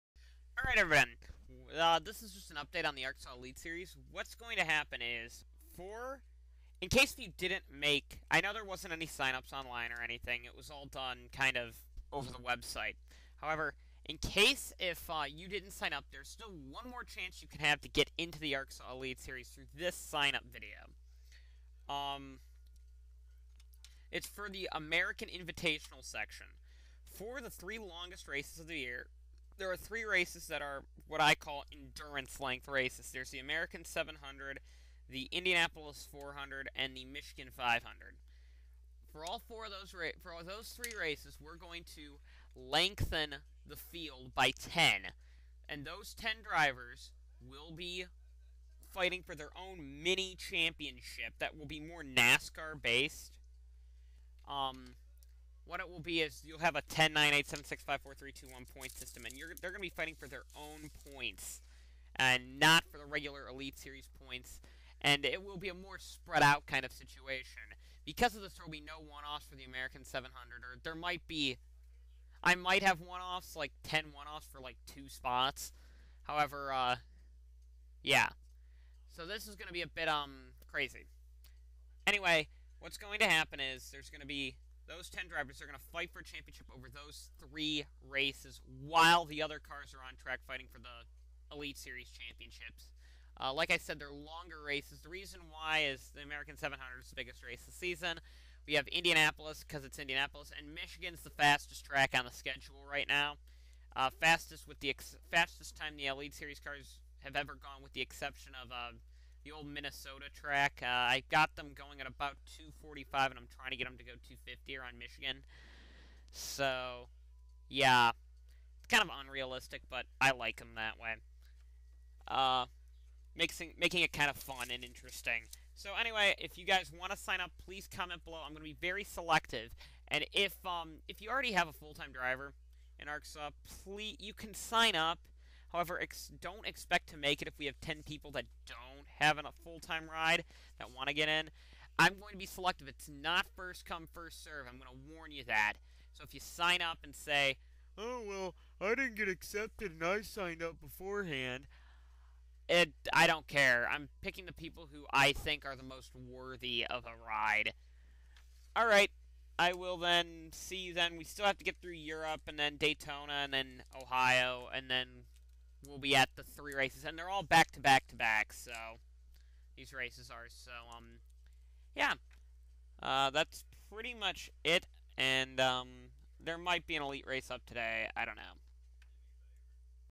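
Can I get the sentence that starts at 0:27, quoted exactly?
For the three longest races of the year, there are three races that are what I call endurance length races.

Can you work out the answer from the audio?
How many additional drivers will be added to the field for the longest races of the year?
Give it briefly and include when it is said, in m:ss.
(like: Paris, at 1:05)
10, at 0:42.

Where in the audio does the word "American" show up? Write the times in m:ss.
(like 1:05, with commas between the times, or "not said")
0:24, 0:33, 1:09, 1:36.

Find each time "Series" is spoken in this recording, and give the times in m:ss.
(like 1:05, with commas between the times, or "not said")
0:03, 0:19, 1:03, 1:31, 1:46.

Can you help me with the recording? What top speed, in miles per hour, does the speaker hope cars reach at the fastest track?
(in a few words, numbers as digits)
250.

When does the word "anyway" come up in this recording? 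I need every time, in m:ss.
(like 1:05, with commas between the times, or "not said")
1:22, 2:05.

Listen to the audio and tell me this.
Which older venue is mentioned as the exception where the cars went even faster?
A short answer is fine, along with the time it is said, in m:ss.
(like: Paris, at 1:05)
Minnesota, at 1:49.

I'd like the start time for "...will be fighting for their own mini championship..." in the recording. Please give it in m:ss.
0:47.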